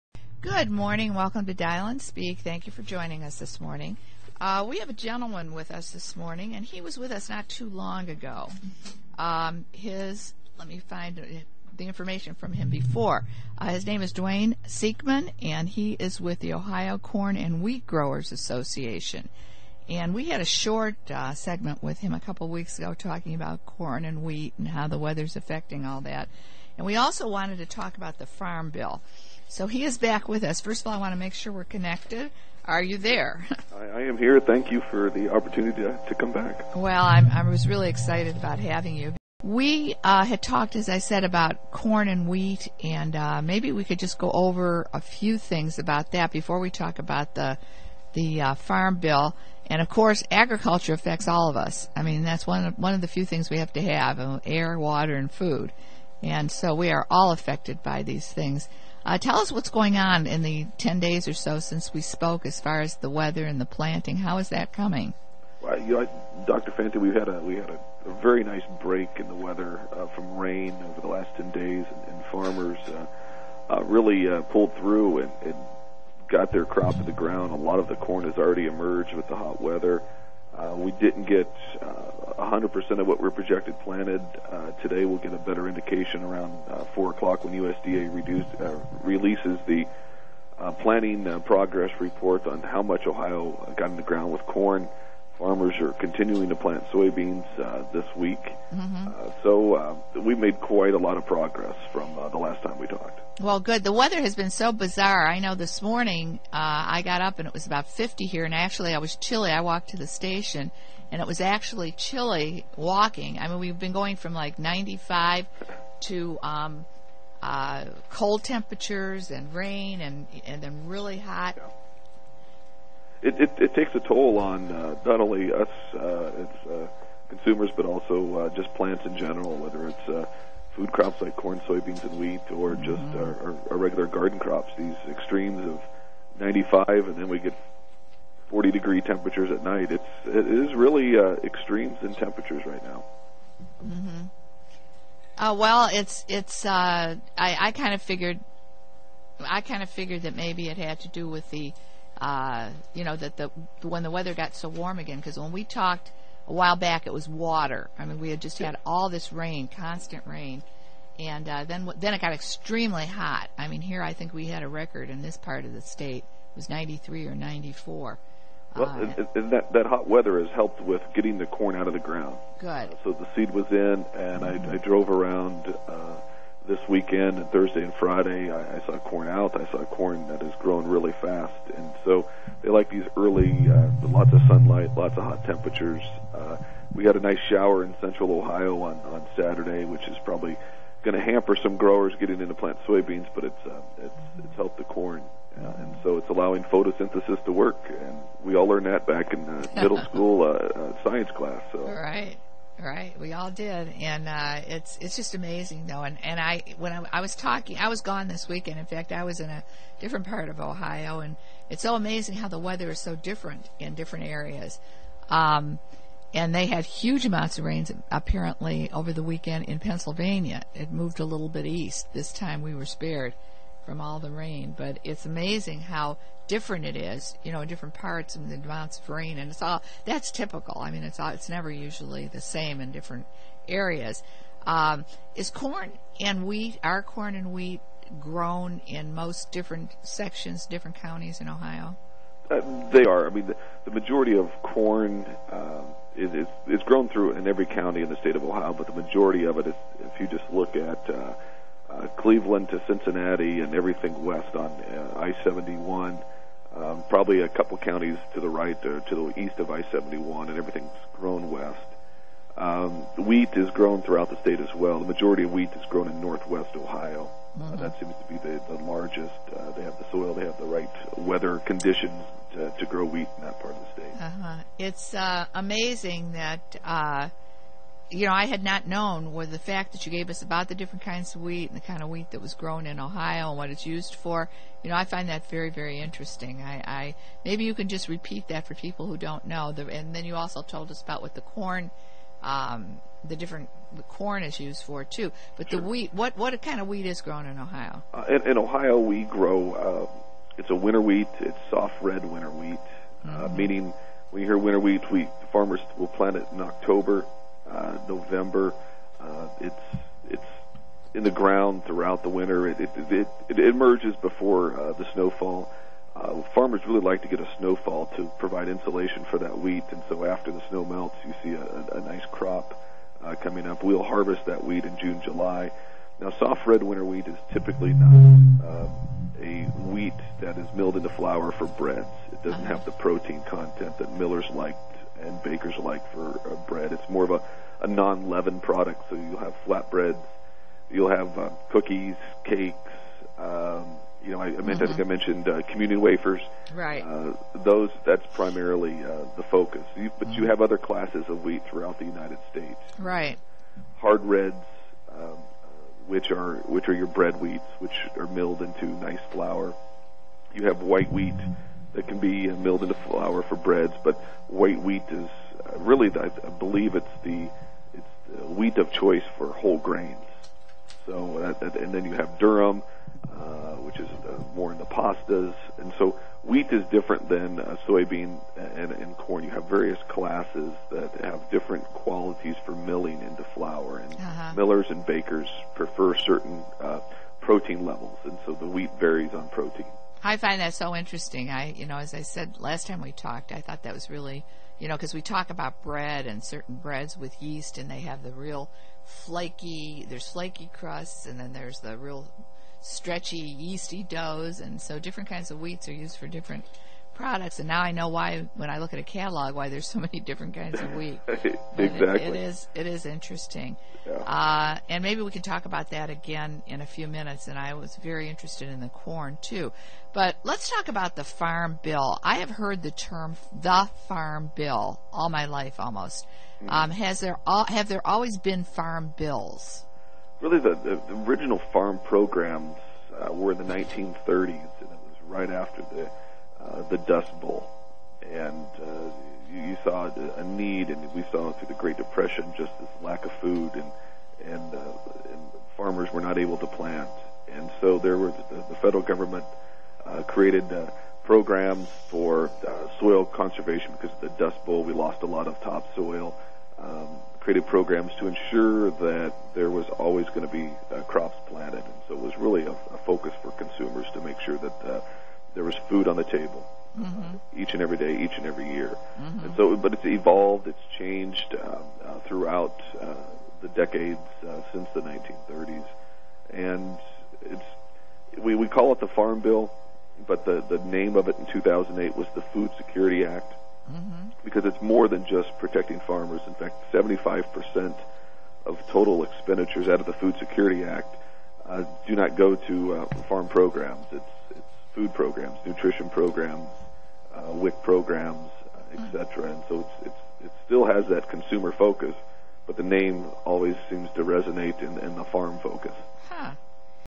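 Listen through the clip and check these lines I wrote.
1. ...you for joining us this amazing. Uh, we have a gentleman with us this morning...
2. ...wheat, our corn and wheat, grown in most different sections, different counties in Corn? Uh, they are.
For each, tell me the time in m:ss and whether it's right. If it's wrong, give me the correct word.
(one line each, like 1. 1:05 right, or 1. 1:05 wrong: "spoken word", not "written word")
1. 0:02 wrong: "morning", not "amazing"
2. 3:56 wrong: "Ohio", not "Corn".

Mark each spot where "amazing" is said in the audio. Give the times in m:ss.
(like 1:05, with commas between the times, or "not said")
3:25, 3:31, 3:45, 4:35.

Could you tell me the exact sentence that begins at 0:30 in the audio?
First of all, I want to make sure we're connected.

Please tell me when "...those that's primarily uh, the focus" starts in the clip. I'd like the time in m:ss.
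5:47.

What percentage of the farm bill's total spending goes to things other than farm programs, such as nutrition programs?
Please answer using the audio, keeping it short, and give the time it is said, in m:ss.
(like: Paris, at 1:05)
75%, at 8:06.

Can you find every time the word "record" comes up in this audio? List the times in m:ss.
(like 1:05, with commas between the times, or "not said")
2:44.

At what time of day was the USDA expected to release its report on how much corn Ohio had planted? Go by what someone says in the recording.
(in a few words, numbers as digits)
4 o'clock.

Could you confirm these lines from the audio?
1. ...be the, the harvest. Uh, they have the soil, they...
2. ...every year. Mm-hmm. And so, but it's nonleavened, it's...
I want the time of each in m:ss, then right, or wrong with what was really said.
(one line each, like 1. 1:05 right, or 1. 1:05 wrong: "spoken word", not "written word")
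1. 4:28 wrong: "largest", not "harvest"
2. 7:48 wrong: "evolved", not "nonleavened".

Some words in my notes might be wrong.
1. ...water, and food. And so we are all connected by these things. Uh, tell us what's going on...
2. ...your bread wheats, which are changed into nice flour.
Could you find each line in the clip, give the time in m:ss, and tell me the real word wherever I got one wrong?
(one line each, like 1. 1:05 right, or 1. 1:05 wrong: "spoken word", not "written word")
1. 0:54 wrong: "affected", not "connected"
2. 5:56 wrong: "milled", not "changed".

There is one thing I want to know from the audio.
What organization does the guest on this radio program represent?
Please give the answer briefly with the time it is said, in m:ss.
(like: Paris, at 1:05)
Ohio Corn and Wheat Growers Association, at 0:16.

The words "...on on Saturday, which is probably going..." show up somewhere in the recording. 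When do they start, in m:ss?
3:08.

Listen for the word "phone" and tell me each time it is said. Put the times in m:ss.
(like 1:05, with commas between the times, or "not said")
not said.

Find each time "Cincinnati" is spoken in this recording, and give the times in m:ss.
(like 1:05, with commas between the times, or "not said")
4:12.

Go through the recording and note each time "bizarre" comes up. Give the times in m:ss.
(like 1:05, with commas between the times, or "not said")
1:44.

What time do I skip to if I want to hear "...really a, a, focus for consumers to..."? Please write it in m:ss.
7:42.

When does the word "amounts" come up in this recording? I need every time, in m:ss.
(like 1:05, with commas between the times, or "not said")
3:37, 3:48.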